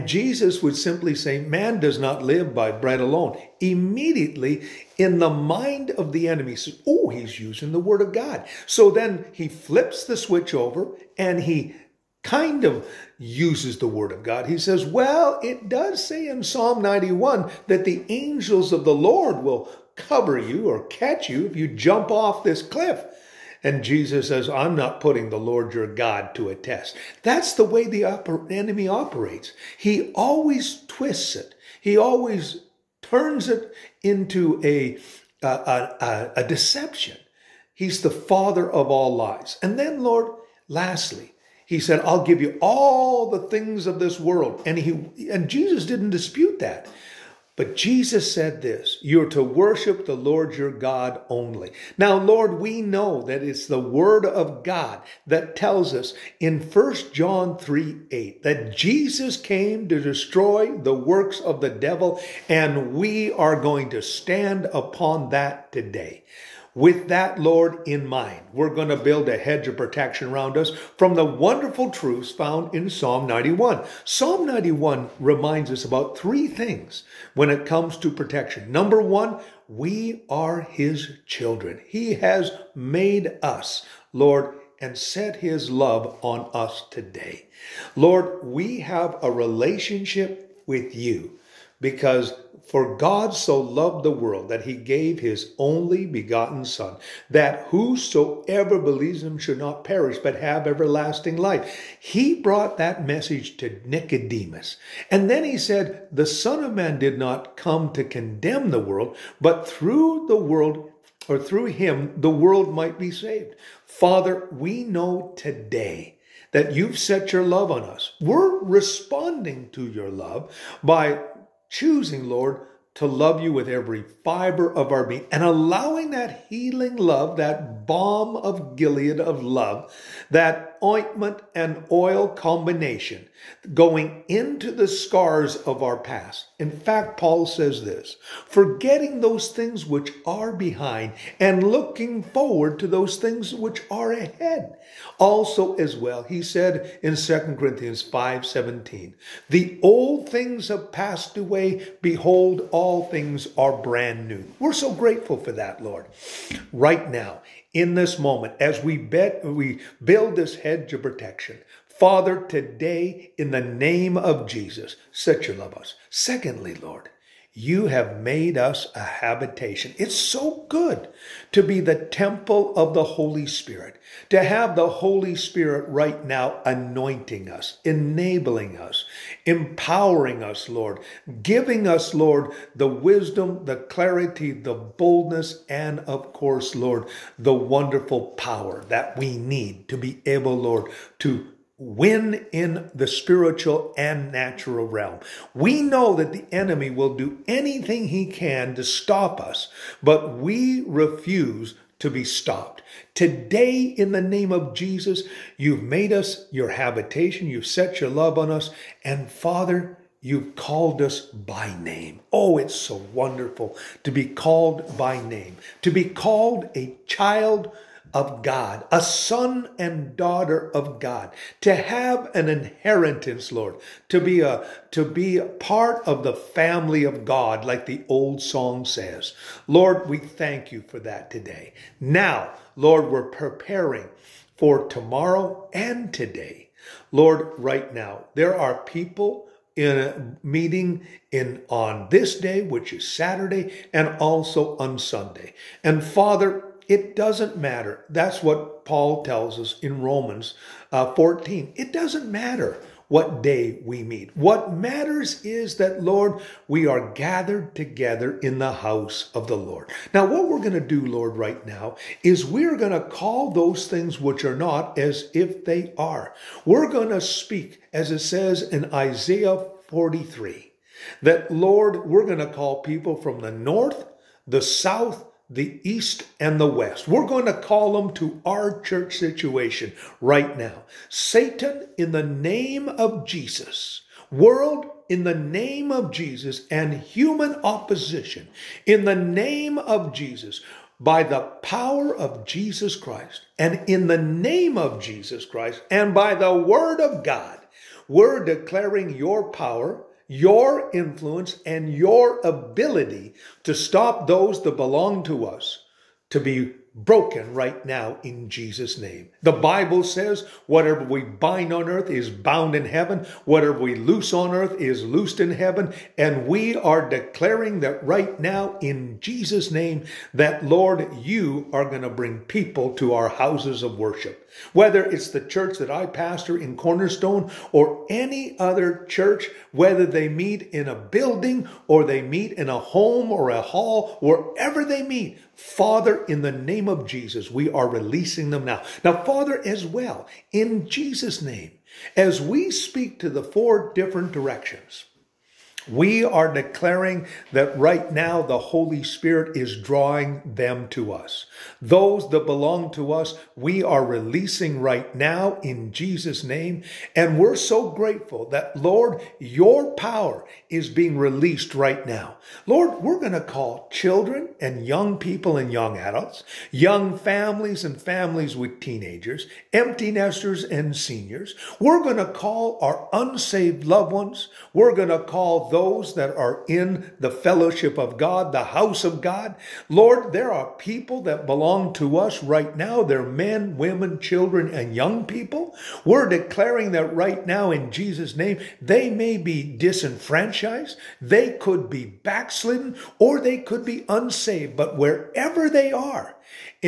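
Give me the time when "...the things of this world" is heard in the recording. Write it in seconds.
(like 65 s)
43 s.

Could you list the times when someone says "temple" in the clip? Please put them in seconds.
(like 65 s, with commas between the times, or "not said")
172 s.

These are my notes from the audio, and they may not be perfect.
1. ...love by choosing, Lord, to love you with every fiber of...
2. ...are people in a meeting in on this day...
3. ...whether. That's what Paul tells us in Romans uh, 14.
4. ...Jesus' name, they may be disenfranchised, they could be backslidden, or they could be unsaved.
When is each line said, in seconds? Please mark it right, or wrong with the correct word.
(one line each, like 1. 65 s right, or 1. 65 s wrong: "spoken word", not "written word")
1. 120 s right
2. 238 s right
3. 247 s wrong: "matter", not "whether"
4. 387 s right.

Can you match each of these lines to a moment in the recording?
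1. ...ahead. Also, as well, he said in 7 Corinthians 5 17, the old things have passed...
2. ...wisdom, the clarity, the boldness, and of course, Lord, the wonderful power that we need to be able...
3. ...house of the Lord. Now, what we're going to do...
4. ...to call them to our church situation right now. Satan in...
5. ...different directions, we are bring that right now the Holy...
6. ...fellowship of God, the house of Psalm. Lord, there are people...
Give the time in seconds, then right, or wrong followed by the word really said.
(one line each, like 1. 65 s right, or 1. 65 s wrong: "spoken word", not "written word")
1. 144 s wrong: "2", not "7"
2. 182 s right
3. 258 s right
4. 277 s right
5. 343 s wrong: "declaring", not "bring"
6. 377 s wrong: "God", not "Psalm".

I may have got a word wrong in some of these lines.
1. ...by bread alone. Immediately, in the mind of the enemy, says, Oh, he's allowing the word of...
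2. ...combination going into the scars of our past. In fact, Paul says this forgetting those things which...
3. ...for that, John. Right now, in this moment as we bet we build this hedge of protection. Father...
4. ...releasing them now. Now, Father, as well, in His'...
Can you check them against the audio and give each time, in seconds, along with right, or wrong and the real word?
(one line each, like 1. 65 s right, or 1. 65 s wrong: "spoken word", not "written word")
1. 2 s wrong: "using", not "allowing"
2. 132 s right
3. 155 s wrong: "Lord", not "John"
4. 337 s wrong: "Jesus", not "His".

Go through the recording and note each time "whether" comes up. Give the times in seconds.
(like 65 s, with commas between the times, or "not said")
324 s, 329 s.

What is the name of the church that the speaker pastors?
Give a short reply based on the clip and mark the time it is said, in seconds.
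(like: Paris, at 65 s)
Cornerstone, at 326 s.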